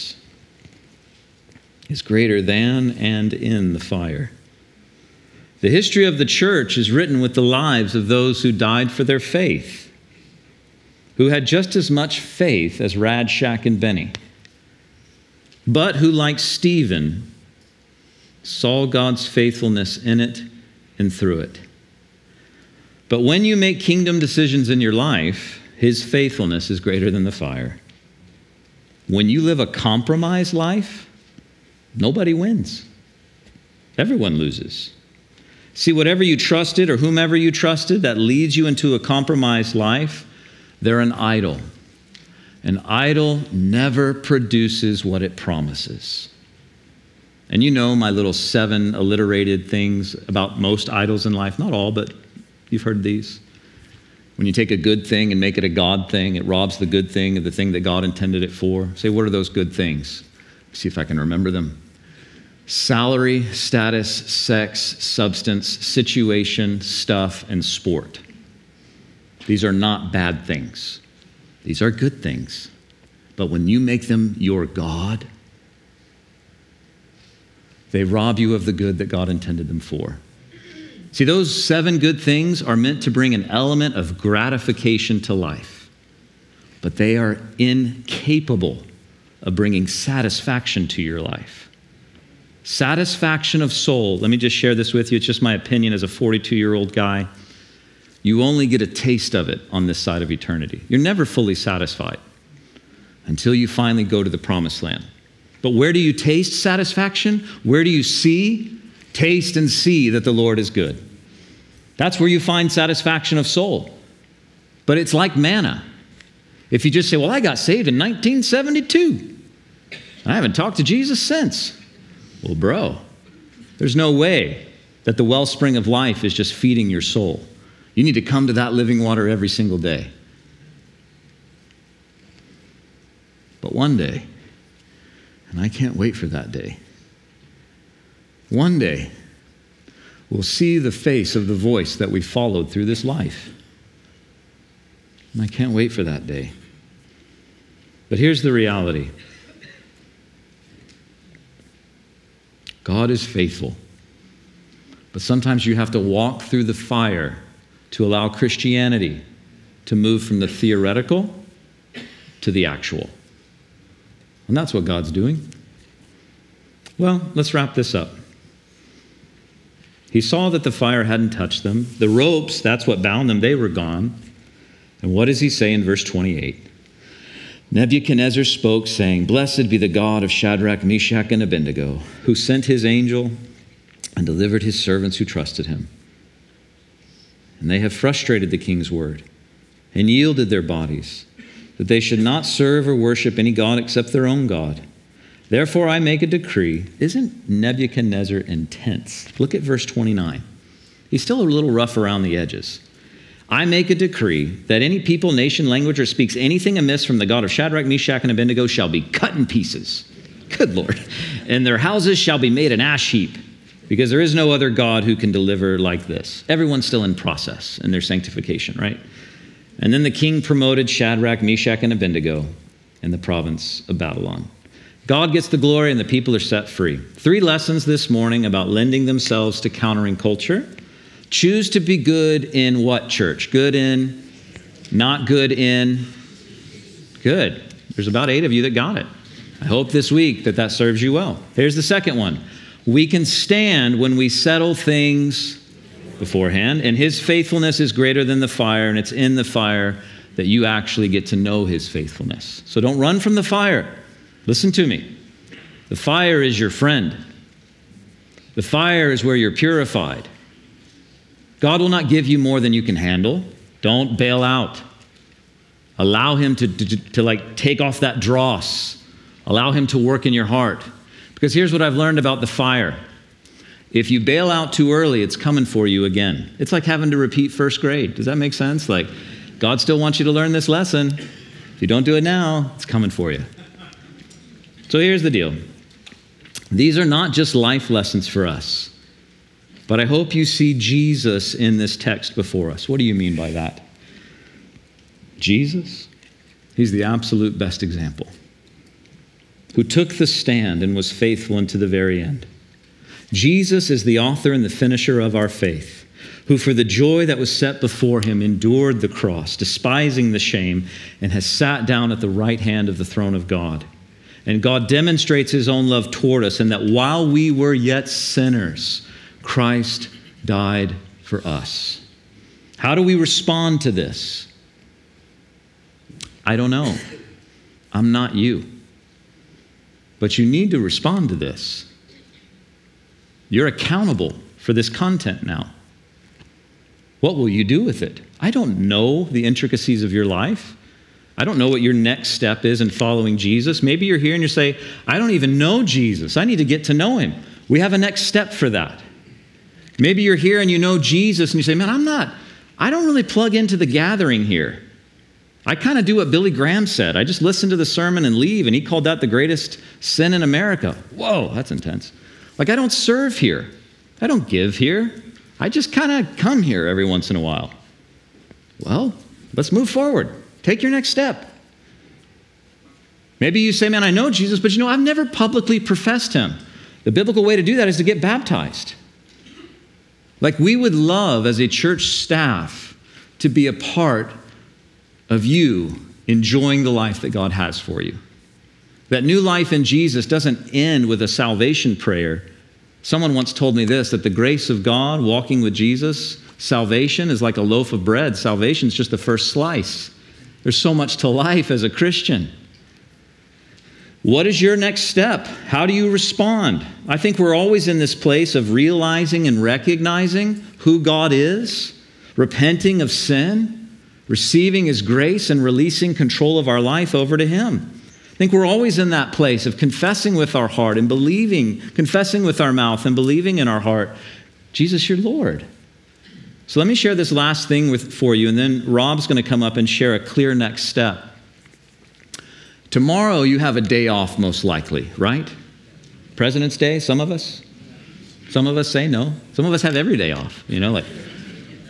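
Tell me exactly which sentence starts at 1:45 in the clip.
But where do you taste satisfaction?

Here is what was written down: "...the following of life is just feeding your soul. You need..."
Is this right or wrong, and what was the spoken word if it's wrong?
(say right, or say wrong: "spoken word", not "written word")
wrong: "wellspring", not "following".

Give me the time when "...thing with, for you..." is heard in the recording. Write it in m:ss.
7:07.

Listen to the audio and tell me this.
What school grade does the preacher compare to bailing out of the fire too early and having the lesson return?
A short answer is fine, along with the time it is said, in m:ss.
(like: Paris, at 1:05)
First grade, at 4:37.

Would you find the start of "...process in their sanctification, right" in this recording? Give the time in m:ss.
3:37.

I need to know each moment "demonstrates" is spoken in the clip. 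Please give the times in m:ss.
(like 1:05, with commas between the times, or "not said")
5:14.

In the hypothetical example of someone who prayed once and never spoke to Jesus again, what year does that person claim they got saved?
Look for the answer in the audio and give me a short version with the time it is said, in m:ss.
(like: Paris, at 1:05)
1972, at 1:57.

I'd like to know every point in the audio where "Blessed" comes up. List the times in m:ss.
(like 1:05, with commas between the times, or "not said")
2:59.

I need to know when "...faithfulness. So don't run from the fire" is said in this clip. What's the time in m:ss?
4:11.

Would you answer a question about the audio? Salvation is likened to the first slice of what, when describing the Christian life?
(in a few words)
A loaf of bread.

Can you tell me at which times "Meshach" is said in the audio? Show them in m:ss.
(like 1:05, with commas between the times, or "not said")
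3:00, 3:27, 3:41.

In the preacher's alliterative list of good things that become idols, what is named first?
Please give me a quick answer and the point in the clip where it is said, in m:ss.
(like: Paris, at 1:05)
Salary, at 1:02.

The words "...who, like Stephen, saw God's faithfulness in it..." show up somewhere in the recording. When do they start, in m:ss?
0:15.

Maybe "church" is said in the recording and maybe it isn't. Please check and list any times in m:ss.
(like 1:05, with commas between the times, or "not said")
0:06, 3:53, 6:21.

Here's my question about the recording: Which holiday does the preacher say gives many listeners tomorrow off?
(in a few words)
Presidents' Day.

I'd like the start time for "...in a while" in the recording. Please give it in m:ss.
6:07.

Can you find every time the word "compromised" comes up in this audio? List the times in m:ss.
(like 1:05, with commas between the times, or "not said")
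0:29, 0:38.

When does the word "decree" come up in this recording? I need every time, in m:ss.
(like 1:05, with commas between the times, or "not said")
3:16, 3:23.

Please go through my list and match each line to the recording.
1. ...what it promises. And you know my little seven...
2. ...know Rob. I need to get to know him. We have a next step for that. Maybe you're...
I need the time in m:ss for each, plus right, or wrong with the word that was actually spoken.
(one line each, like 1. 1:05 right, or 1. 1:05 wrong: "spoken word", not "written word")
1. 0:45 right
2. 5:45 wrong: "Jesus", not "Rob".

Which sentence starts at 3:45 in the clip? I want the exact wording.
God gets the glory and the people are set free.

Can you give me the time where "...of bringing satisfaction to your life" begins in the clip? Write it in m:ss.
1:29.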